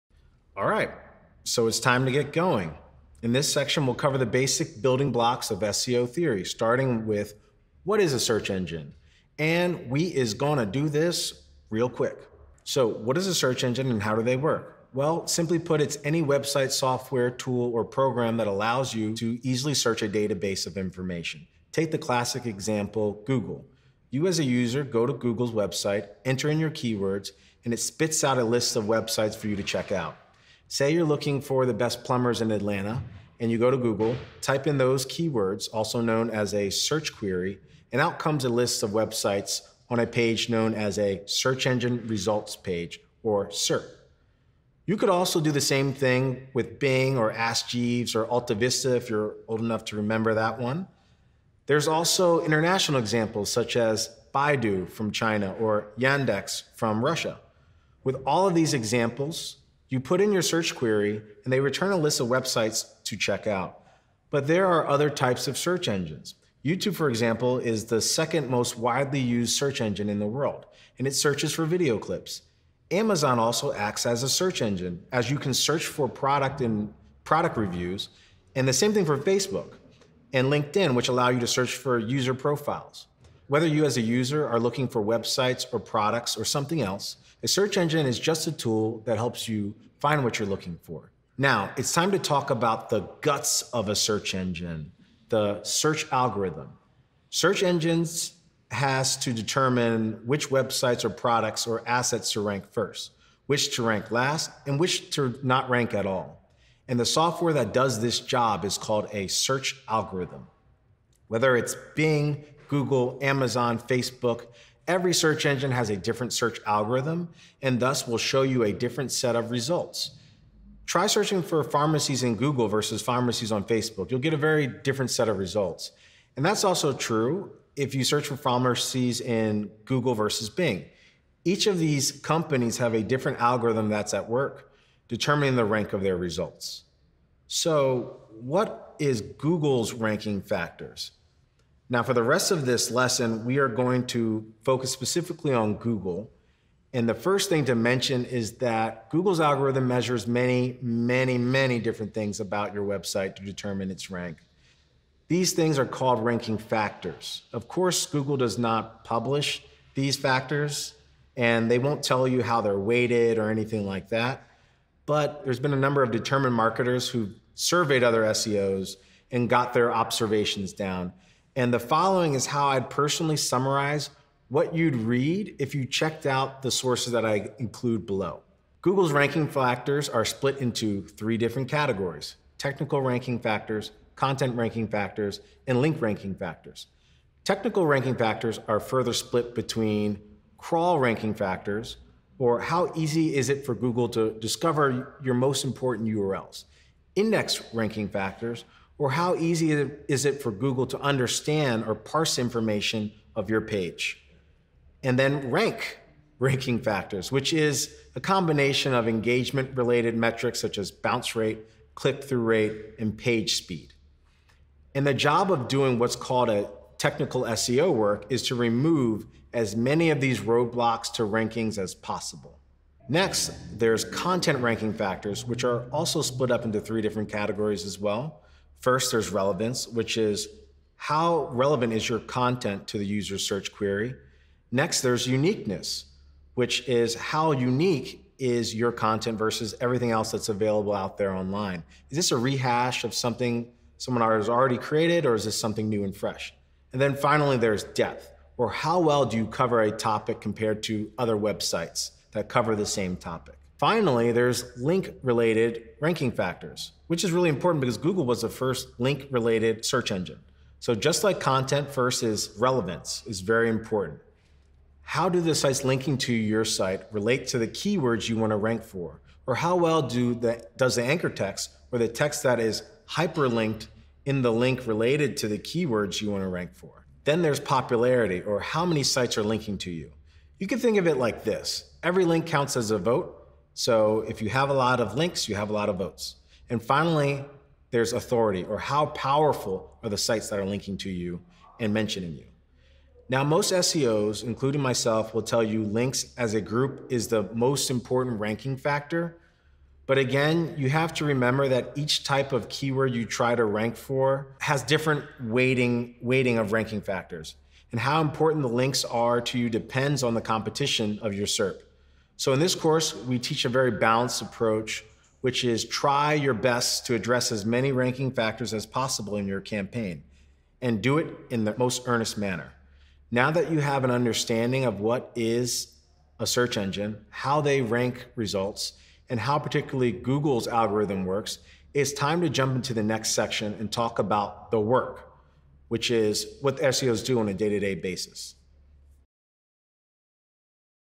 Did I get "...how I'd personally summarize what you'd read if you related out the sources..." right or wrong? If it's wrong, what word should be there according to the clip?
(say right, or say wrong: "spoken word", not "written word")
wrong: "checked", not "related".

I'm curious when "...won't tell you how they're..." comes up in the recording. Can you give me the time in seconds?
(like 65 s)
161 s.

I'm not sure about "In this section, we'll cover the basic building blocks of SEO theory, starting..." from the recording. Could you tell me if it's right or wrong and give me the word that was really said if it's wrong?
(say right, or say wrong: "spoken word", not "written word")
right.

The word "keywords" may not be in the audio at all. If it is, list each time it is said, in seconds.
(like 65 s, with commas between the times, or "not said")
26 s, 35 s, 267 s, 275 s, 302 s.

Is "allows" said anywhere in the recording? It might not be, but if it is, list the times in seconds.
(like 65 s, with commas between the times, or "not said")
18 s, 81 s.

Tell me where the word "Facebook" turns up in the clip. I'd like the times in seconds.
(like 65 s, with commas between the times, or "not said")
79 s, 113 s, 123 s.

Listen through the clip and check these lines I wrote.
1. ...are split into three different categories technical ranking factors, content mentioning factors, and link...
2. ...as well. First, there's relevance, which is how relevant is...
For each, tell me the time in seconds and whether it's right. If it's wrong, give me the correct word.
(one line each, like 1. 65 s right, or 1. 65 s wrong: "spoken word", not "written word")
1. 180 s wrong: "ranking", not "mentioning"
2. 227 s right.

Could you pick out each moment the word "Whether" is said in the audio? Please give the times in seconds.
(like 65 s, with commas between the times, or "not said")
83 s, 111 s.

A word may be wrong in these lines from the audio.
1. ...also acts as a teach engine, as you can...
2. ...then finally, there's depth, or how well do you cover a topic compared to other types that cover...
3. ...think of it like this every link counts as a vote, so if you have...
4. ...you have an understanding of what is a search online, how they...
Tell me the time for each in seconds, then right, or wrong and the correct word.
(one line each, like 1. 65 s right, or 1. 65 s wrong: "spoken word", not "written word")
1. 73 s wrong: "search", not "teach"
2. 246 s wrong: "websites", not "types"
3. 280 s right
4. 323 s wrong: "engine", not "online".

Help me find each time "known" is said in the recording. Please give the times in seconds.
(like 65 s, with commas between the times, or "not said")
35 s, 40 s.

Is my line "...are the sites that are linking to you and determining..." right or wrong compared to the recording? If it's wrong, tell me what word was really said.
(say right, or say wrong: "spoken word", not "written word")
wrong: "mentioning", not "determining".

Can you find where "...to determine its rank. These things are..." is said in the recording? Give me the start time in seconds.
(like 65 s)
153 s.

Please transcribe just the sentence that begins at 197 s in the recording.
Index ranking factors or how easy is it for Google to understand or parse information of your page?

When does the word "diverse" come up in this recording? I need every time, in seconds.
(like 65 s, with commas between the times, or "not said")
not said.